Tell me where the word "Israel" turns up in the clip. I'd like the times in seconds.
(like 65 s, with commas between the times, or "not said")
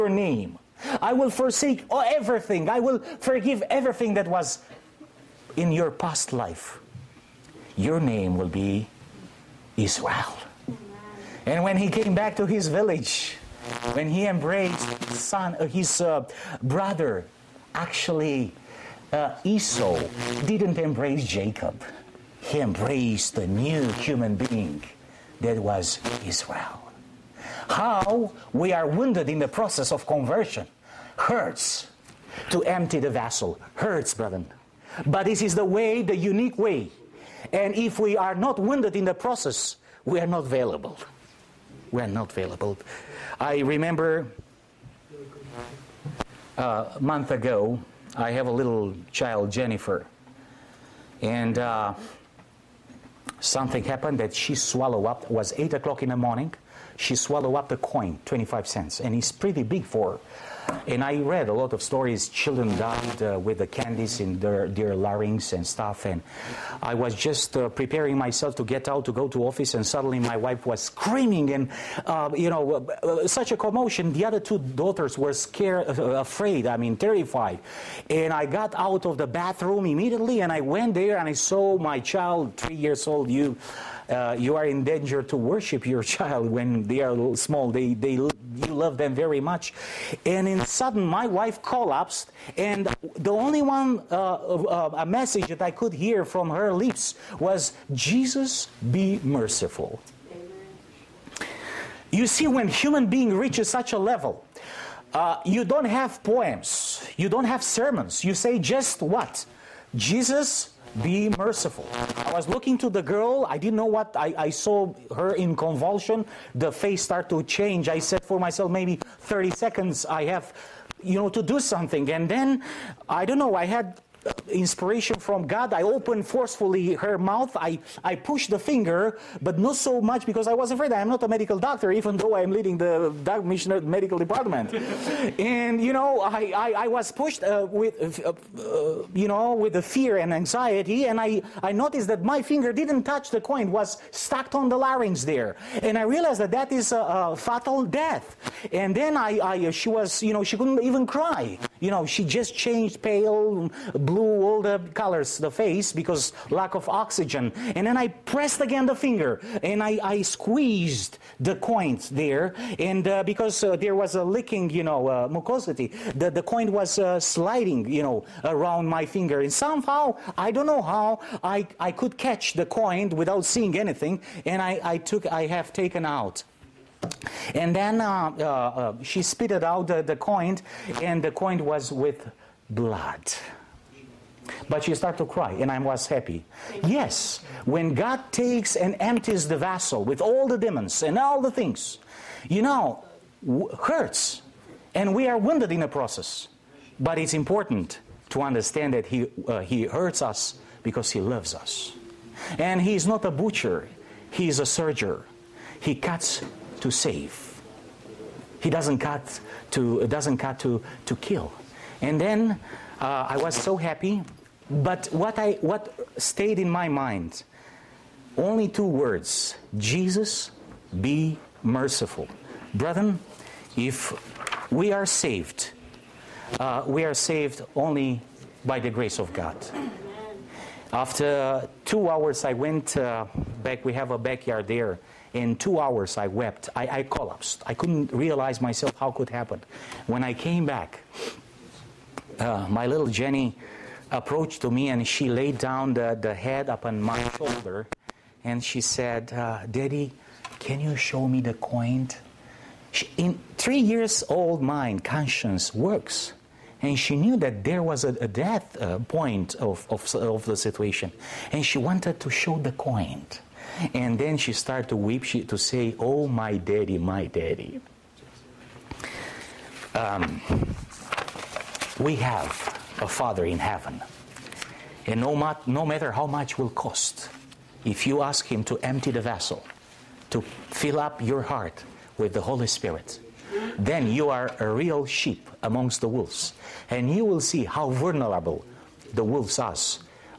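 9 s, 26 s.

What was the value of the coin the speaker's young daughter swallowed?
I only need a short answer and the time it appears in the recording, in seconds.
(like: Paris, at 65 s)
25 cents, at 58 s.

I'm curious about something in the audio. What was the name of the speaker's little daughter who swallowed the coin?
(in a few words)
Jennifer.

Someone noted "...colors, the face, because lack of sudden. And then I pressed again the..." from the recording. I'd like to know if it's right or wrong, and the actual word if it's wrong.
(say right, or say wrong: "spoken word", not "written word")
wrong: "oxygen", not "sudden".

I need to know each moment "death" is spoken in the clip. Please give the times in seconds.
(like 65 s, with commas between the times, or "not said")
147 s, 258 s.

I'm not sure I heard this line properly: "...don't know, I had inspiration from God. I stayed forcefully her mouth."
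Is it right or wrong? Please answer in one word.
wrong.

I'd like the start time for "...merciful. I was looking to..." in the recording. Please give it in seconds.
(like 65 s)
111 s.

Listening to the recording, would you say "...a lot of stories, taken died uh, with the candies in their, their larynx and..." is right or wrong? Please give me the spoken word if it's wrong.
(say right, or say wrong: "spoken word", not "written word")
wrong: "children", not "taken".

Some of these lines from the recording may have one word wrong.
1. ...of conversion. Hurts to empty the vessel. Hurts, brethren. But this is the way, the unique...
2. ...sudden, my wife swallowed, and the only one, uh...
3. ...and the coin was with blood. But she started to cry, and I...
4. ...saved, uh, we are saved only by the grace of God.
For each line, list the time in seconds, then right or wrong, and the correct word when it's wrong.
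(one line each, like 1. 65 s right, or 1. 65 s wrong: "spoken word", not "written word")
1. 29 s right
2. 90 s wrong: "collapsed", not "swallowed"
3. 181 s right
4. 225 s right.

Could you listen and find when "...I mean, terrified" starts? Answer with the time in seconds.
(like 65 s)
76 s.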